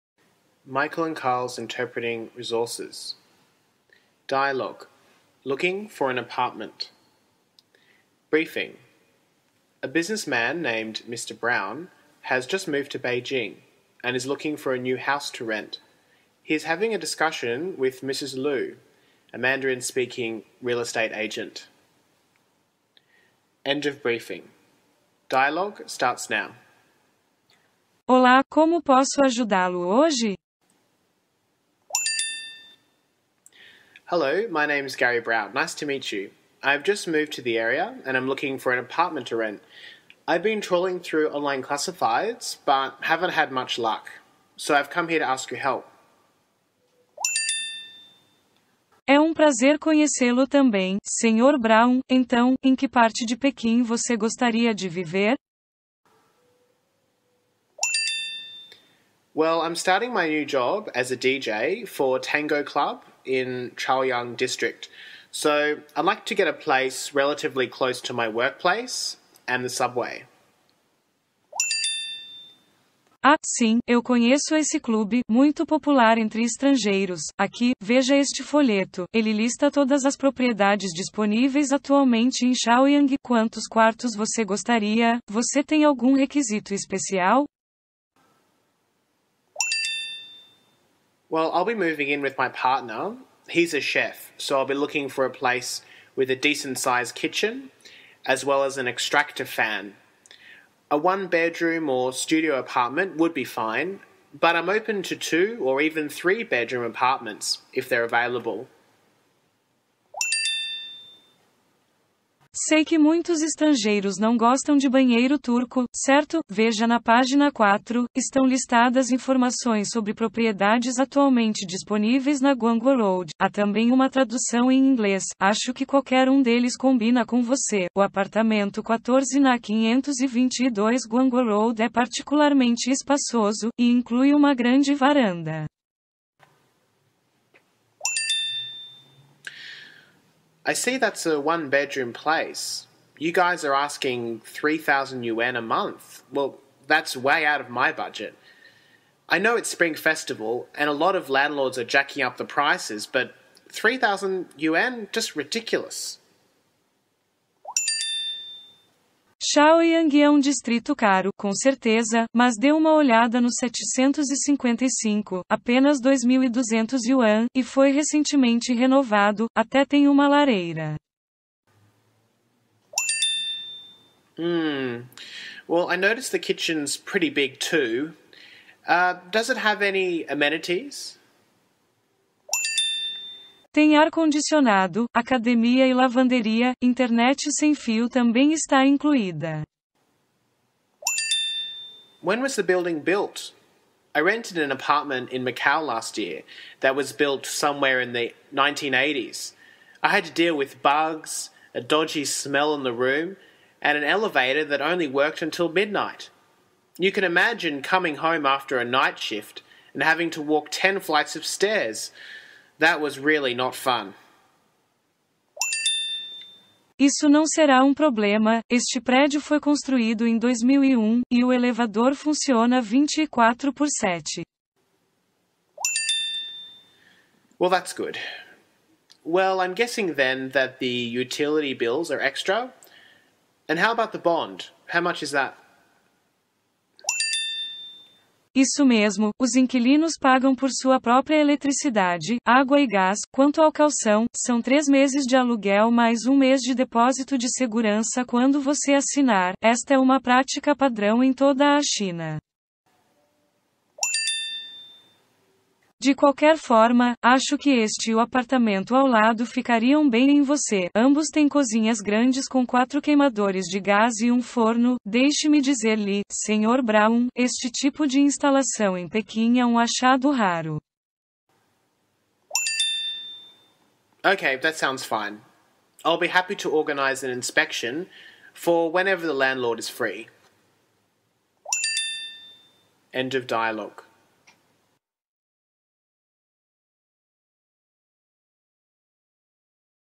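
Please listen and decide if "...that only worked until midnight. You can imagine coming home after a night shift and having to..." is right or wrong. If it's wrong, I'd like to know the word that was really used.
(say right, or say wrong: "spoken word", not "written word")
right.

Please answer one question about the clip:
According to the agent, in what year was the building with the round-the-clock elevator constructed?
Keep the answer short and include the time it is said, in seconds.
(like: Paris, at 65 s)
2001, at 220 s.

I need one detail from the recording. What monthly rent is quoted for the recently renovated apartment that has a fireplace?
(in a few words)
2,200 yuan.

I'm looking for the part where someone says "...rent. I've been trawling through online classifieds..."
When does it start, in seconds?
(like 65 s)
39 s.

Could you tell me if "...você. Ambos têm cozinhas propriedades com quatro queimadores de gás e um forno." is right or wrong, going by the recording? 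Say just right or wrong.
wrong.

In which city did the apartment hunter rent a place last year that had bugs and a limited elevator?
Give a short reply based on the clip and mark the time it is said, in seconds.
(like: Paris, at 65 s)
Macau, at 195 s.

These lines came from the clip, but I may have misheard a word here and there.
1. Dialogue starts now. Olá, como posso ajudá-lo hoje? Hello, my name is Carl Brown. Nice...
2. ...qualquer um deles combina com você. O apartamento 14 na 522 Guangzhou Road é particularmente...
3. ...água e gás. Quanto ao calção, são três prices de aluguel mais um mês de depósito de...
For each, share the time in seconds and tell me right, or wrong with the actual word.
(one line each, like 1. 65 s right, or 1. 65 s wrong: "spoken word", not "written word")
1. 25 s wrong: "Gary", not "Carl"
2. 125 s right
3. 242 s wrong: "meses", not "prices".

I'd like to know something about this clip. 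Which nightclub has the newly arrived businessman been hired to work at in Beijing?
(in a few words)
Tango Club.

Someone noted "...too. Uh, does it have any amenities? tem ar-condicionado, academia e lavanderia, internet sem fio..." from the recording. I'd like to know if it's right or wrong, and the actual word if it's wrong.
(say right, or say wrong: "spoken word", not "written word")
right.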